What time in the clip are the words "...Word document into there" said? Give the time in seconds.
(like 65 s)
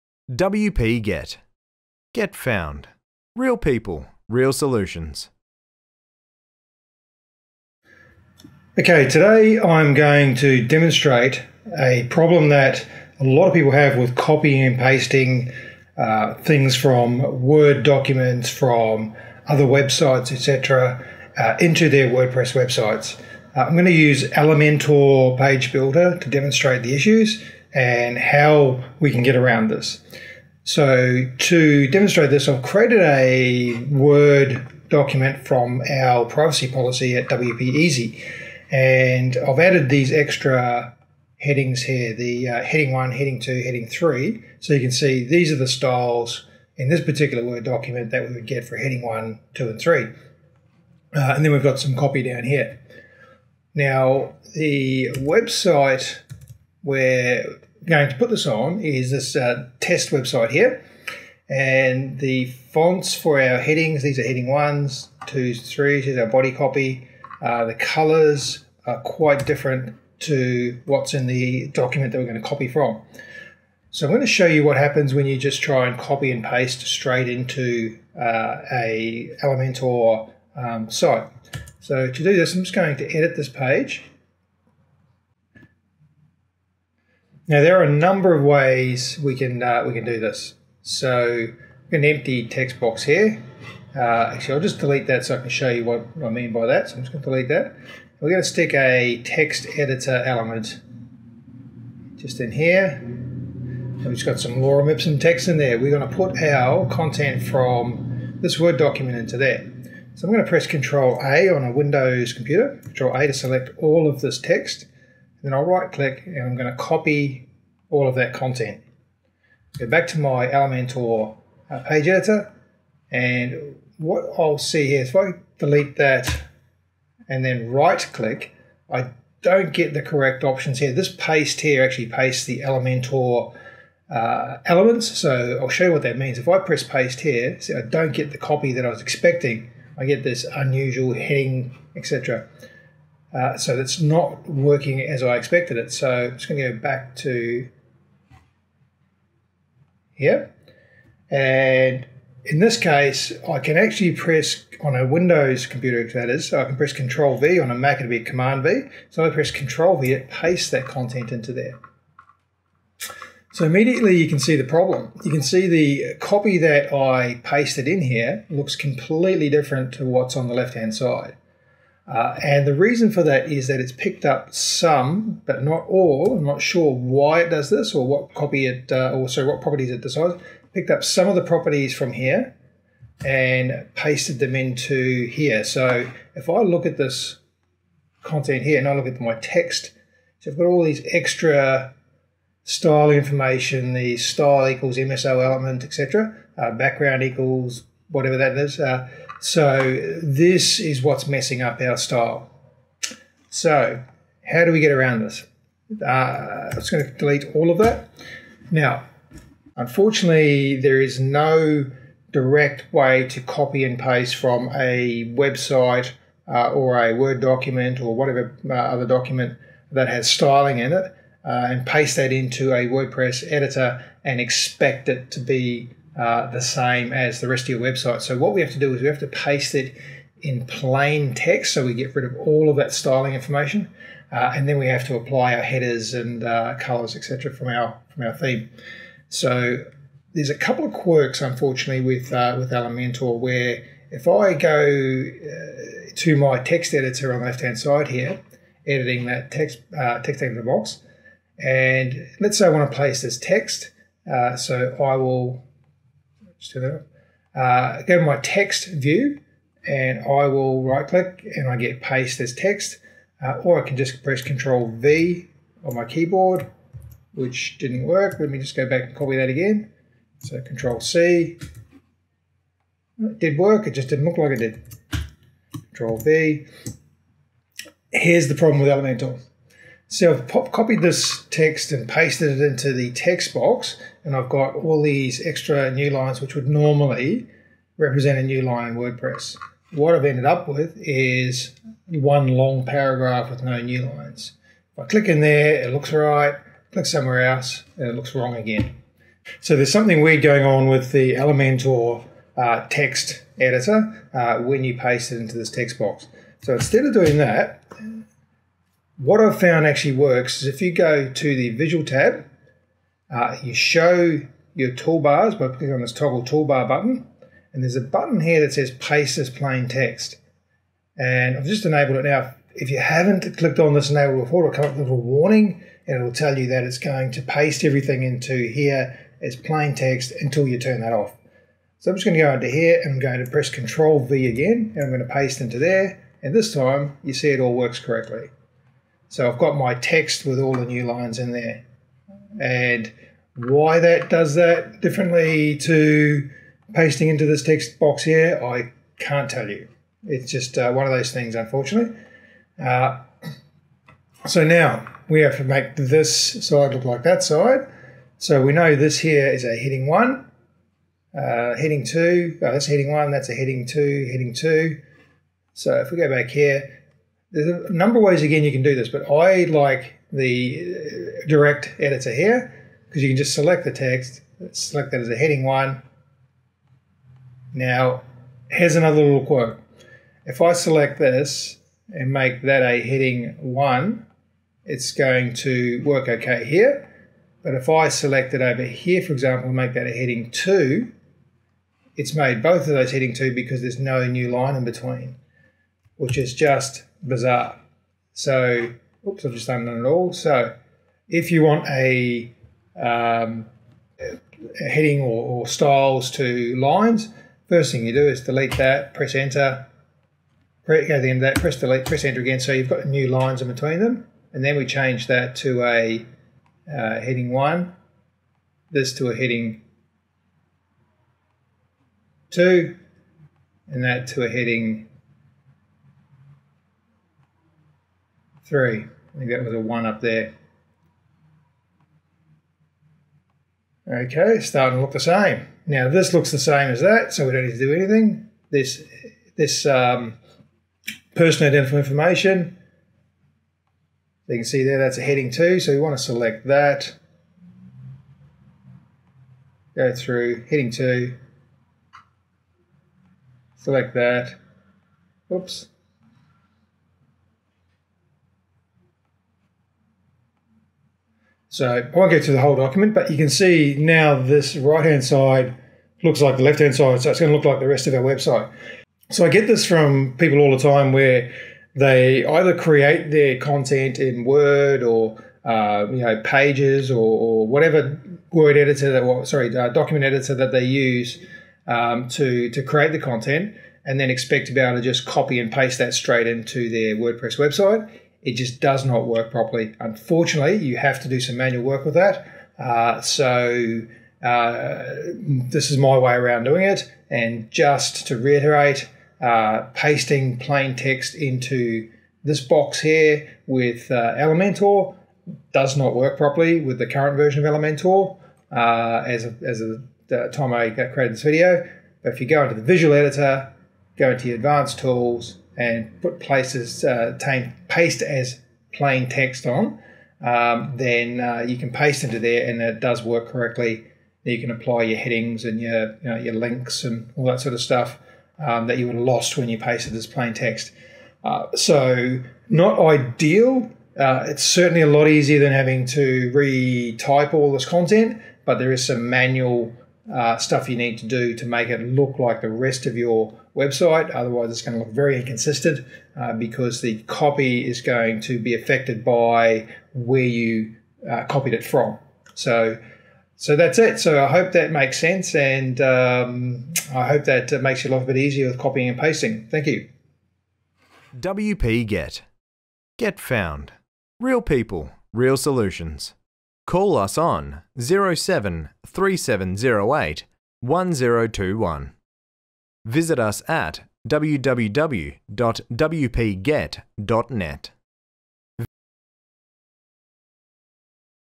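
108 s.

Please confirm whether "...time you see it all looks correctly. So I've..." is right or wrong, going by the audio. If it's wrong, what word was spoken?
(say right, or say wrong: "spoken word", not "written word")
wrong: "works", not "looks".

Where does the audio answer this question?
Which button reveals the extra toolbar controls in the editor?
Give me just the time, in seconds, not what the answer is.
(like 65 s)
316 s.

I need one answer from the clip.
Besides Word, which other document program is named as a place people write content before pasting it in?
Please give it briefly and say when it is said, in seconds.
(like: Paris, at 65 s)
Pages, at 476 s.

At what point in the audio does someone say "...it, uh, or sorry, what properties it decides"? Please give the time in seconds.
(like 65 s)
178 s.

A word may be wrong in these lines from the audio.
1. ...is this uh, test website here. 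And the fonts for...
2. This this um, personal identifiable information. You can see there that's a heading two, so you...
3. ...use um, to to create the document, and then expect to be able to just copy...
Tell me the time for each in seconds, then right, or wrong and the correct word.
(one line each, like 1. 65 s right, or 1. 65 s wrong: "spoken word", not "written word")
1. 58 s right
2. 438 s right
3. 480 s wrong: "content", not "document".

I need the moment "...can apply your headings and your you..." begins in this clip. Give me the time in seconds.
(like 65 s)
524 s.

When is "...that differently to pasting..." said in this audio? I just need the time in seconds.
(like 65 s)
344 s.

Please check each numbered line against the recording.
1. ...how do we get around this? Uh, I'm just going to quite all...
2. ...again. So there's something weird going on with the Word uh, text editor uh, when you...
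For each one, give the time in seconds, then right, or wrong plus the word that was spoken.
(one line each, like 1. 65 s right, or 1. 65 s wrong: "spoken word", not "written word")
1. 204 s wrong: "delete", not "quite"
2. 298 s wrong: "Elementor", not "Word".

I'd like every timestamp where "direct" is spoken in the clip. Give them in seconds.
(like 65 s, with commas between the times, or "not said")
212 s, 371 s.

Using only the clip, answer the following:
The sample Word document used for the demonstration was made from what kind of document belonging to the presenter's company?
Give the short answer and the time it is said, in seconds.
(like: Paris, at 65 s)
Privacy policy, at 36 s.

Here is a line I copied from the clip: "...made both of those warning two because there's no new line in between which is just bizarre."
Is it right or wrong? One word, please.
wrong.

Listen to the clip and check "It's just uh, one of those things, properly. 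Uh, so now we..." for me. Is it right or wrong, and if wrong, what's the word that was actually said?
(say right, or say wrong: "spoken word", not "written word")
wrong: "unfortunately", not "properly".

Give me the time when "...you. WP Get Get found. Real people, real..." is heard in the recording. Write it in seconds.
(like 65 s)
559 s.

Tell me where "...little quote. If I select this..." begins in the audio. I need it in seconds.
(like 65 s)
379 s.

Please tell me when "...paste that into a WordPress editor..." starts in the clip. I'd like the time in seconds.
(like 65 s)
221 s.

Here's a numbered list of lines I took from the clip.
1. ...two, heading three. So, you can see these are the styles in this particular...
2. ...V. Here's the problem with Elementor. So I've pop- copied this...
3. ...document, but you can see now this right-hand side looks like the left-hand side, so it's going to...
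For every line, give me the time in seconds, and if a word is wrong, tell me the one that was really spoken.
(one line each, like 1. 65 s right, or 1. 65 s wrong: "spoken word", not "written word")
1. 43 s right
2. 276 s right
3. 462 s right.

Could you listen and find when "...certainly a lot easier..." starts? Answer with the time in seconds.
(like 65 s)
534 s.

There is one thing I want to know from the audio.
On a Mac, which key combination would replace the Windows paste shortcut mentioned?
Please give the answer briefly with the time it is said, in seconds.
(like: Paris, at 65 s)
Command V, at 158 s.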